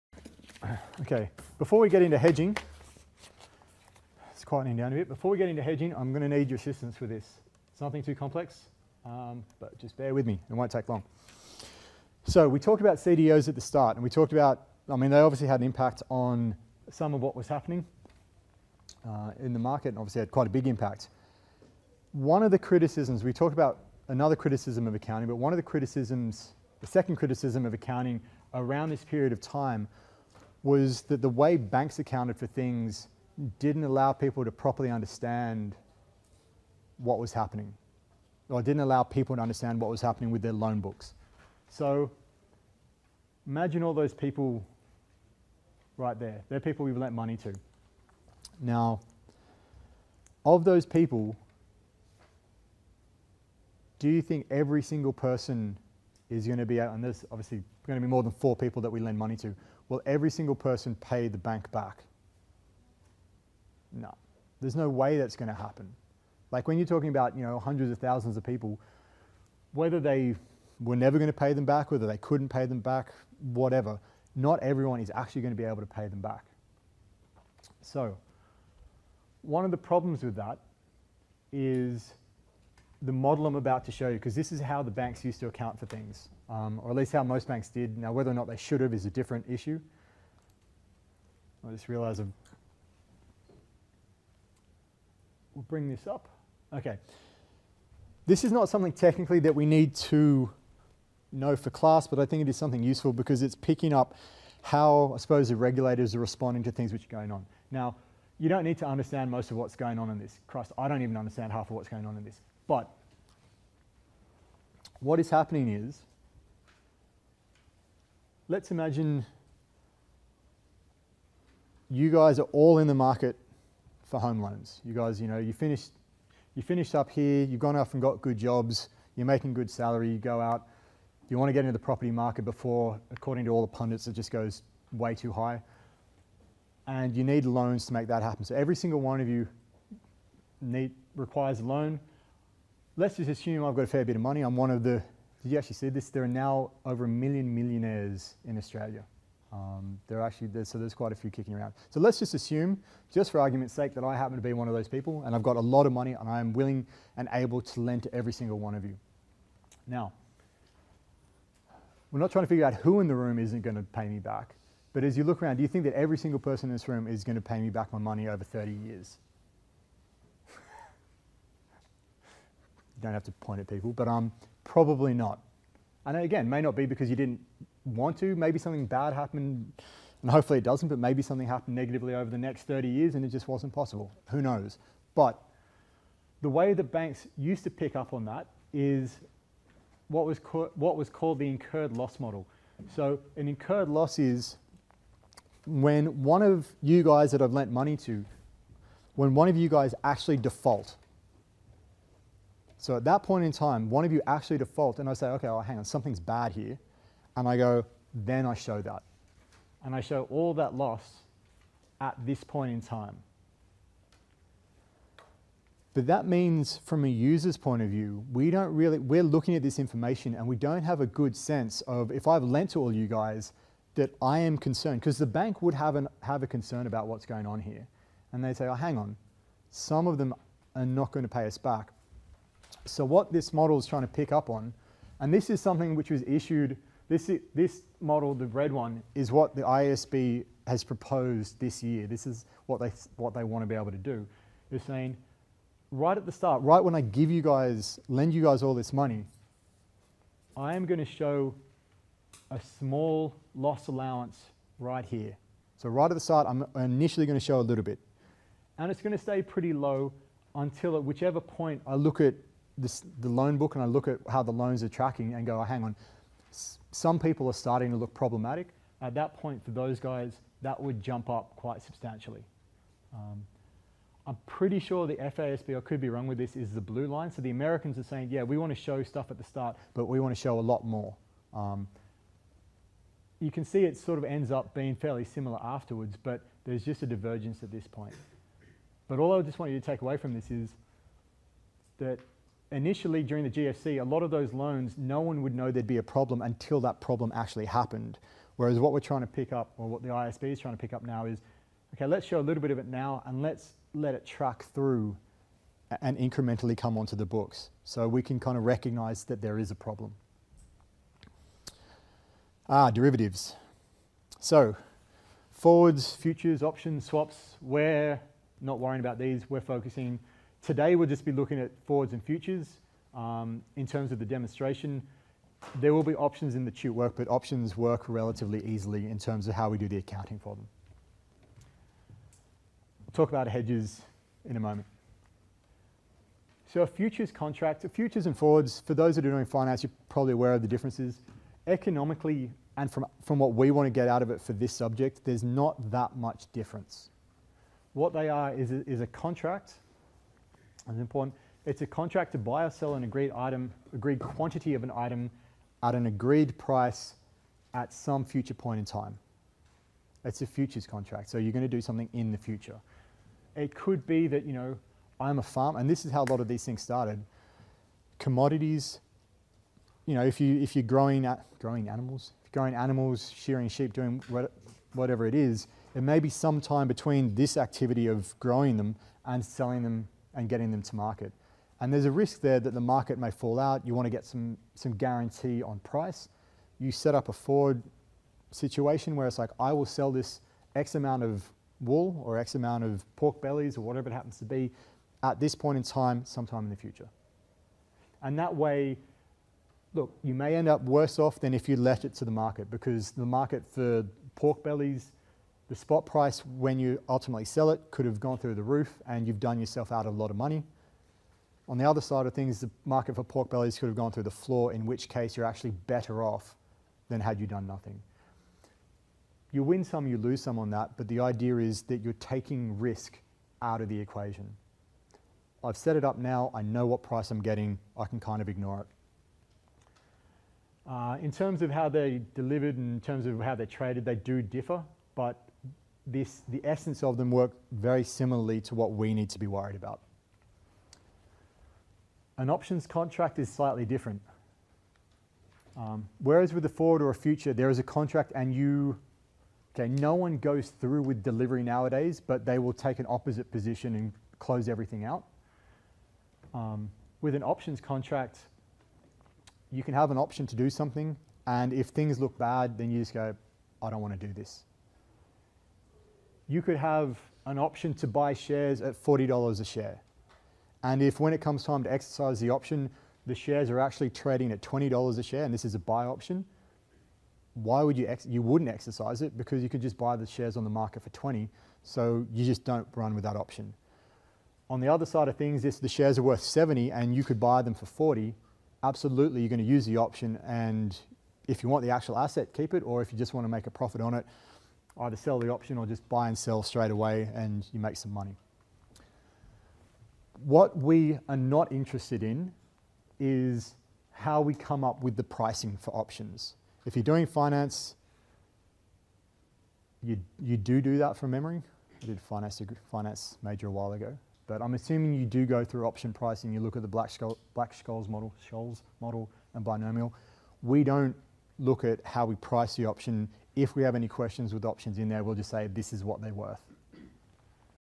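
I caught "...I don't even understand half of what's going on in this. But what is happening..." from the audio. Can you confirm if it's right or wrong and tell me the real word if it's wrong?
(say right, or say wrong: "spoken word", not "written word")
right.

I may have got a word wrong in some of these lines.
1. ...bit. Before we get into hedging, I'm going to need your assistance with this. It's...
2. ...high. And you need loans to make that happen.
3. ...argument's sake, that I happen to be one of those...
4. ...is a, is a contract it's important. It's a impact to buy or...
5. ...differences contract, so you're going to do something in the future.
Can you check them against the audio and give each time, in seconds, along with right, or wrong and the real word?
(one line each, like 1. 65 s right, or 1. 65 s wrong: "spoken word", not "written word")
1. 4 s right
2. 135 s right
3. 153 s right
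4. 348 s wrong: "contract", not "impact"
5. 360 s wrong: "futures", not "differences".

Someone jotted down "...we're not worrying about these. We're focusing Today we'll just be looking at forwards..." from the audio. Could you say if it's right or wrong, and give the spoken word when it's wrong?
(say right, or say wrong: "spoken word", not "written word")
right.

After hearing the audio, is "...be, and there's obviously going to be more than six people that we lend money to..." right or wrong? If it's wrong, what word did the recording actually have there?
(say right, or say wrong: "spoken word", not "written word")
wrong: "four", not "six".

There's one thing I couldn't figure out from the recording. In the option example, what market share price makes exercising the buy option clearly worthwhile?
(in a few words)
$70.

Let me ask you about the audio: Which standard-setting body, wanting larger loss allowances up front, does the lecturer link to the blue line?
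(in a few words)
FASB.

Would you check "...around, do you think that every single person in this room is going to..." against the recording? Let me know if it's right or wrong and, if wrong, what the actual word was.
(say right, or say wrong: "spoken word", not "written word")
right.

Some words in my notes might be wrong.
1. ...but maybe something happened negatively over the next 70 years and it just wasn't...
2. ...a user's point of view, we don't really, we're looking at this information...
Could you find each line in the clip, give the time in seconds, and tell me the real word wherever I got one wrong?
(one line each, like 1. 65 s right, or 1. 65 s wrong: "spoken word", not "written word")
1. 180 s wrong: "30", not "70"
2. 217 s right.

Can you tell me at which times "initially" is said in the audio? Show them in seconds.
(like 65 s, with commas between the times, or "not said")
256 s, 292 s.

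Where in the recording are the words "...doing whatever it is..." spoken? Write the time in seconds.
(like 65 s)
373 s.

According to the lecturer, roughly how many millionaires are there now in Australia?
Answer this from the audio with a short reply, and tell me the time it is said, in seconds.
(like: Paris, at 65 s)
over a million, at 146 s.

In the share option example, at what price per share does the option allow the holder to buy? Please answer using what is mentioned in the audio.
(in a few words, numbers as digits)
$40.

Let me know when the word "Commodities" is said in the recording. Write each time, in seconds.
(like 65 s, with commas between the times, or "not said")
368 s.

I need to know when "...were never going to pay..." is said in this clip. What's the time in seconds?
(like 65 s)
70 s.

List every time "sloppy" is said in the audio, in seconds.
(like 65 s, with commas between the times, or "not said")
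not said.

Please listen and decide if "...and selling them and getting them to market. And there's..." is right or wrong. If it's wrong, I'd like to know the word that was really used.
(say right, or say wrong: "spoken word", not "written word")
right.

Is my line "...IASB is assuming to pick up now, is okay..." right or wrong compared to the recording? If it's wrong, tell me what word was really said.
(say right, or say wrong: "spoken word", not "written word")
wrong: "trying", not "assuming".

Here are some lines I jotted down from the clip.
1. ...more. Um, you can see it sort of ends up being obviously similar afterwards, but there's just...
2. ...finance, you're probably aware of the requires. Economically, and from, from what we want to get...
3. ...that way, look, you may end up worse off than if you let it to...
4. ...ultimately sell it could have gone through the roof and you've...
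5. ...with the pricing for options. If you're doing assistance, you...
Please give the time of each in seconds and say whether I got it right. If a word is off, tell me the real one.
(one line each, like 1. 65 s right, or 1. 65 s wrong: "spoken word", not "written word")
1. 280 s wrong: "fairly", not "obviously"
2. 339 s wrong: "differences", not "requires"
3. 398 s right
4. 407 s right
5. 505 s wrong: "finance", not "assistance".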